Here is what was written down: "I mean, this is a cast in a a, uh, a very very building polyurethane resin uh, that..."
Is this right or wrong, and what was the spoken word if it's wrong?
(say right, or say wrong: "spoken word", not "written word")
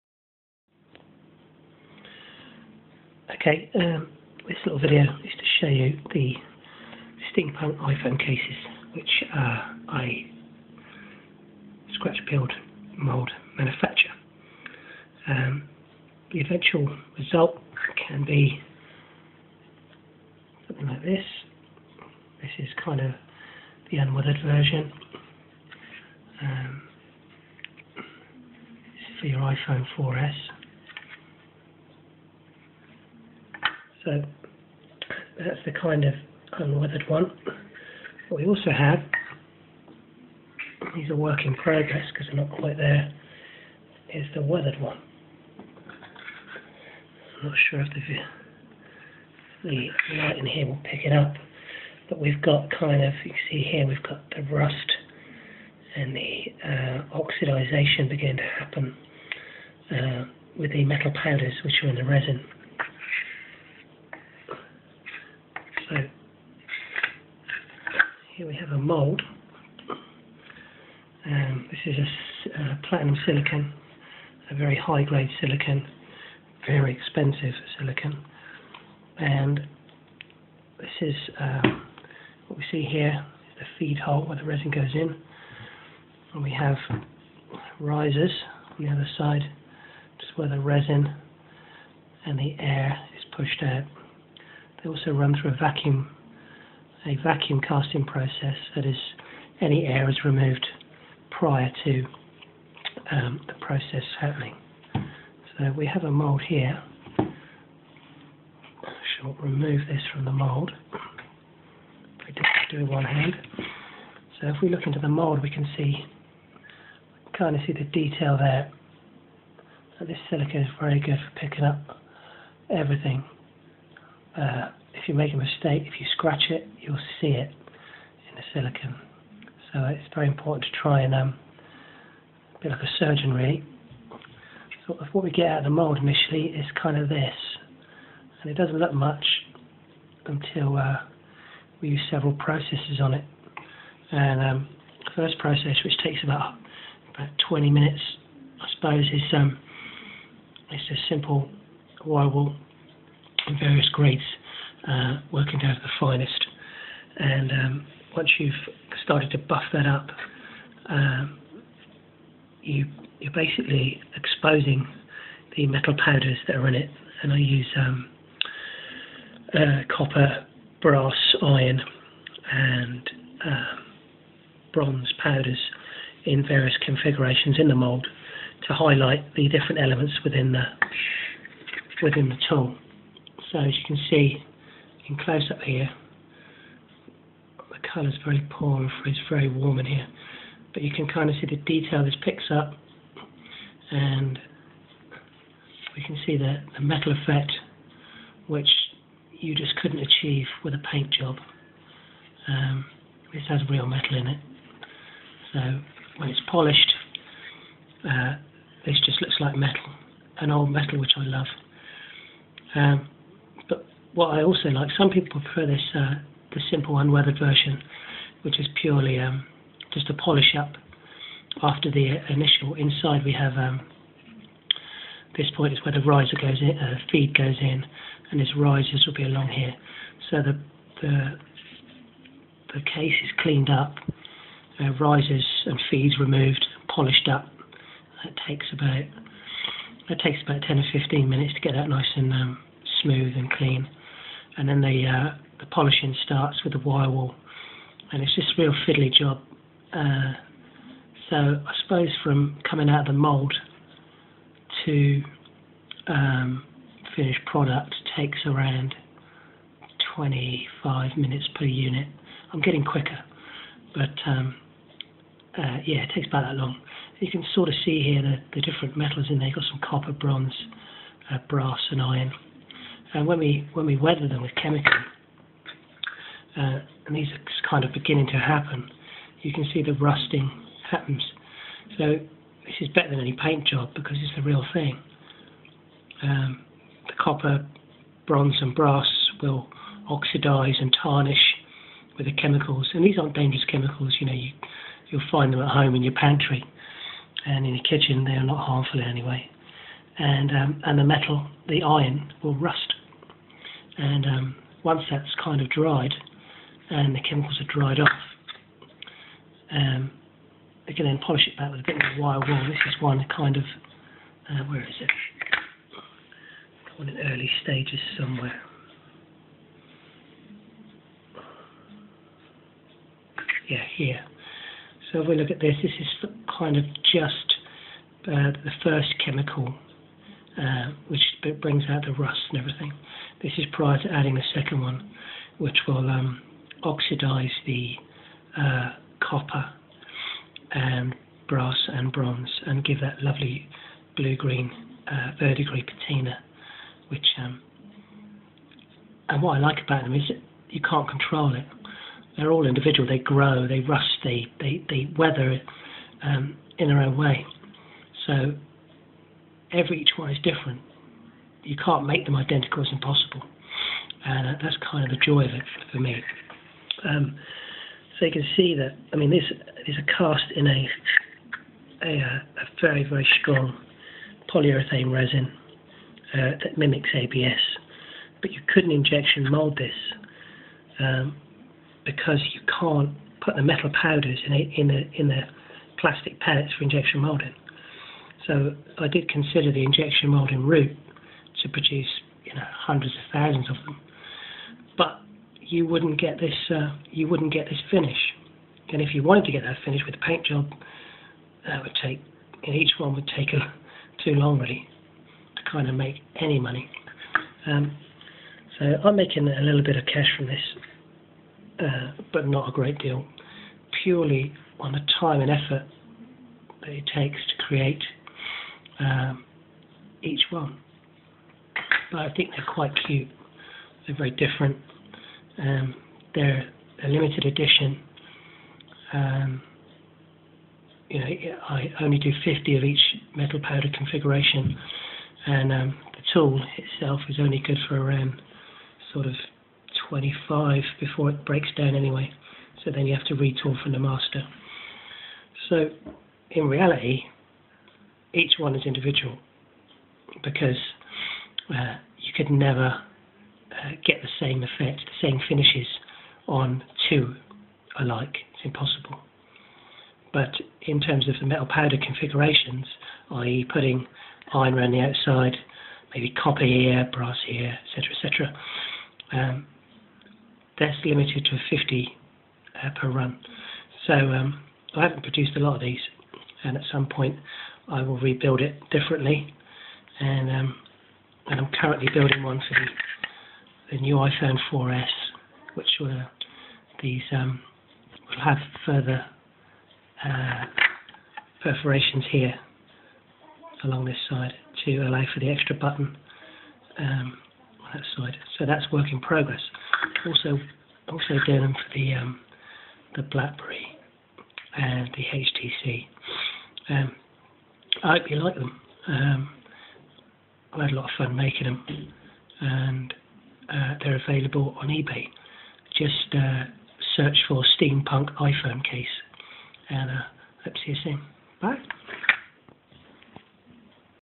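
wrong: "strong", not "building".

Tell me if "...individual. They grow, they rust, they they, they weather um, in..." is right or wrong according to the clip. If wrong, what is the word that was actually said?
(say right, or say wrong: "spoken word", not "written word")
right.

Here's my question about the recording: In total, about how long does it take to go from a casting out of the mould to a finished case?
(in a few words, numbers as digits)
25 minutes.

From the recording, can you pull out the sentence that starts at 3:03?
So as you can see in close up here, the colour is very poor and it's very warm in here.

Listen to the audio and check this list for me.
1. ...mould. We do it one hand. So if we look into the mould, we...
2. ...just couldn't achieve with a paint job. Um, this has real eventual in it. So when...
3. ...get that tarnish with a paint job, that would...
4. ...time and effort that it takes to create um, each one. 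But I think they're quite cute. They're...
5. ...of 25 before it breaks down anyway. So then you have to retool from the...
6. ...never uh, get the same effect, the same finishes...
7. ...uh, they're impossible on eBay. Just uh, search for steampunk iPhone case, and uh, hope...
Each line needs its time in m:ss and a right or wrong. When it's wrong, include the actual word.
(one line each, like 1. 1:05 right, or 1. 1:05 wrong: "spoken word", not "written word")
1. 1:50 right
2. 3:19 wrong: "metal", not "eventual"
3. 6:39 wrong: "finish", not "tarnish"
4. 6:55 right
5. 7:19 right
6. 7:32 right
7. 8:33 wrong: "available", not "impossible".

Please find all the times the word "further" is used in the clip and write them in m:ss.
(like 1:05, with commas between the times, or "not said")
8:08.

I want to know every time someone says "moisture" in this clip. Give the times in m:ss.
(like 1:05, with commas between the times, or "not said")
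not said.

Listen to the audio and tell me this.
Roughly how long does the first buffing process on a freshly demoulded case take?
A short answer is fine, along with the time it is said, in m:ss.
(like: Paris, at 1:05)
20 minutes, at 2:27.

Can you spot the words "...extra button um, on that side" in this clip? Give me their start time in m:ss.
8:15.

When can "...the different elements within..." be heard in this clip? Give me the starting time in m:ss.
2:59.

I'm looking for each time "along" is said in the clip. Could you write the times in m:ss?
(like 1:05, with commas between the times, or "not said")
3:49, 8:13.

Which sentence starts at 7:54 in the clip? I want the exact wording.
So um, I haven't produced a lot of these, and at some point I will rebuild it differently.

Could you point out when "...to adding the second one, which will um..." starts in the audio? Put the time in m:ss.
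5:34.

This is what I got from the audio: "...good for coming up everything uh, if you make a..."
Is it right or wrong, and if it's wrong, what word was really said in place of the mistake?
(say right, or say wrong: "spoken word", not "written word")
wrong: "picking", not "coming".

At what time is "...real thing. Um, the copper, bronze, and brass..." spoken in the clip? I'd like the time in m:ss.
4:44.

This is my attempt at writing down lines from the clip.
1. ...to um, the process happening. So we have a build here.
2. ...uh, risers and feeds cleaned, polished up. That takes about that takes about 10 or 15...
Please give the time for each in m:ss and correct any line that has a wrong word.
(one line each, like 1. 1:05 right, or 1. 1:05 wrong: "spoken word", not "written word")
1. 1:41 wrong: "mould", not "build"
2. 3:54 wrong: "removed", not "cleaned".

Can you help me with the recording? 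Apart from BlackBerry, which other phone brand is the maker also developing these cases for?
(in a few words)
HTC.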